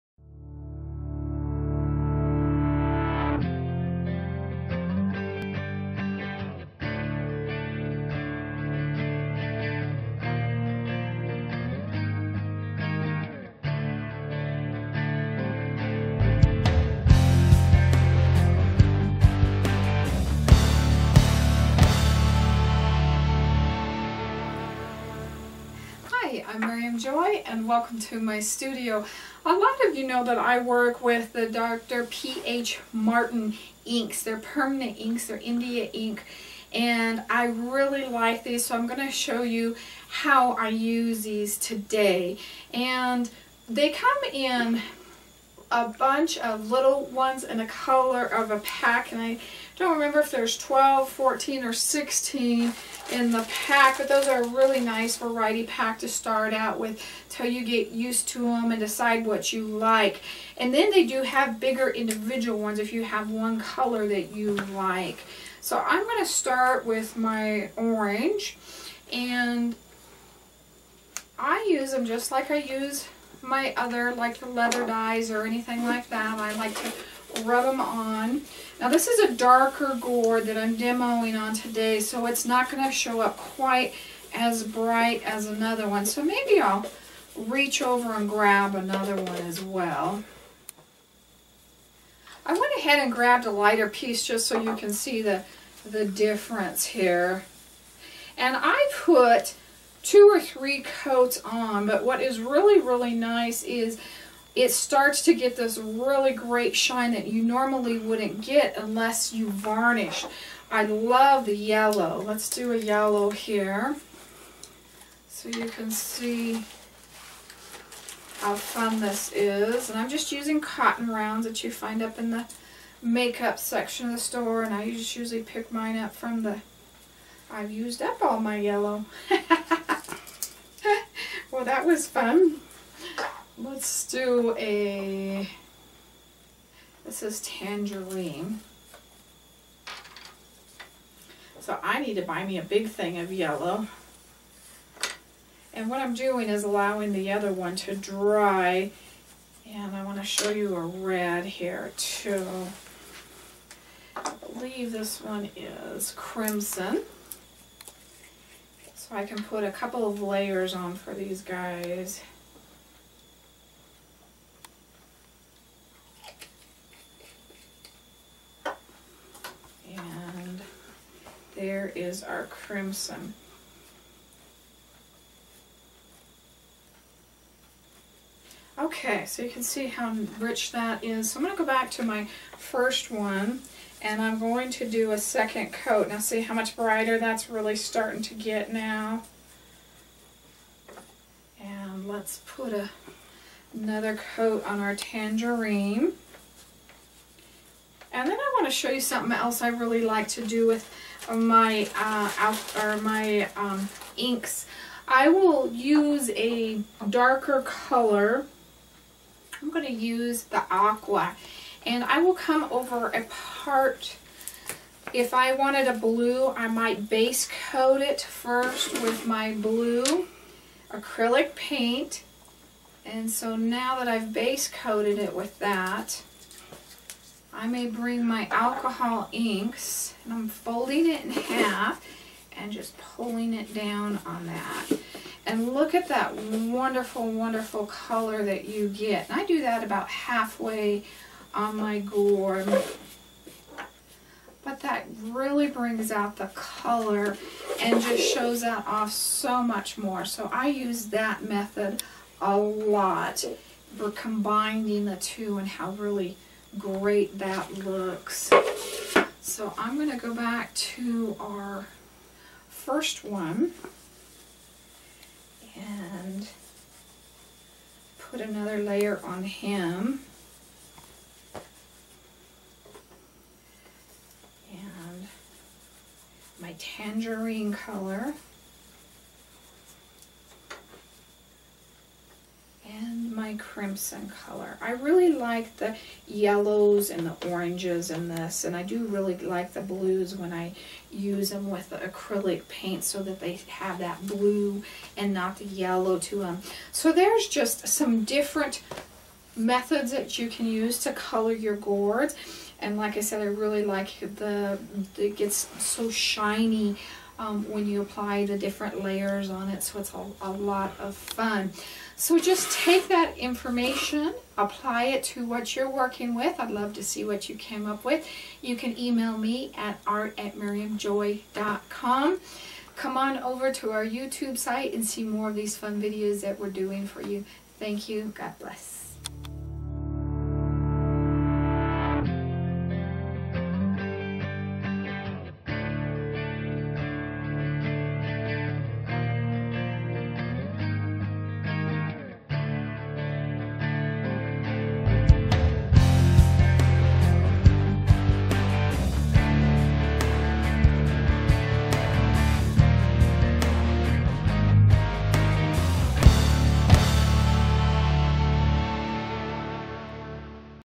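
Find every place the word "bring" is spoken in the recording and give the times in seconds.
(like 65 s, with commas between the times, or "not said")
227 s, 245 s.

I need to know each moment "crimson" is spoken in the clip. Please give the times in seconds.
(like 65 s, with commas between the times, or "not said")
156 s, 172 s, 283 s.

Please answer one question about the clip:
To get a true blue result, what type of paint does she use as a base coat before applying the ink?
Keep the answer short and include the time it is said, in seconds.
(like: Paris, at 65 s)
Blue acrylic paint, at 219 s.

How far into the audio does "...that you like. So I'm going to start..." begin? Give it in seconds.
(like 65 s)
64 s.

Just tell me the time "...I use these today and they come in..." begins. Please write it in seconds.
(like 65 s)
40 s.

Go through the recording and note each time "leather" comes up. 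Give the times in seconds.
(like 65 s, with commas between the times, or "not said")
74 s.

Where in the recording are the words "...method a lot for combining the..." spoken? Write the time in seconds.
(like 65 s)
251 s.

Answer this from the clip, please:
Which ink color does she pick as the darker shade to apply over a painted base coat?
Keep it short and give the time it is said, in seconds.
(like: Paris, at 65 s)
Aqua, at 210 s.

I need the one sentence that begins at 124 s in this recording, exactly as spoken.
And I just usually pick mine up from the...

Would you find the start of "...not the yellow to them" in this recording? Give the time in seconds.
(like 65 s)
295 s.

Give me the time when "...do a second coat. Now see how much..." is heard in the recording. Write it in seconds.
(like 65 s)
184 s.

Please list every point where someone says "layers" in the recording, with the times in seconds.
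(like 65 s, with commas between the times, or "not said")
160 s, 268 s, 309 s.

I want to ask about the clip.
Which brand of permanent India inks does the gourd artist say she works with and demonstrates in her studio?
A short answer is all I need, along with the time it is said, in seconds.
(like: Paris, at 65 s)
Dr. P.H. Martin, at 31 s.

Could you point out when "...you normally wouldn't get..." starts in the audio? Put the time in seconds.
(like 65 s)
107 s.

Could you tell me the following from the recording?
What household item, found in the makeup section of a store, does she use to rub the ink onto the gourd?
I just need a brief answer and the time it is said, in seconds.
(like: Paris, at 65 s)
Cotton rounds, at 120 s.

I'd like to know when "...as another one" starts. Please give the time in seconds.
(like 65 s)
85 s.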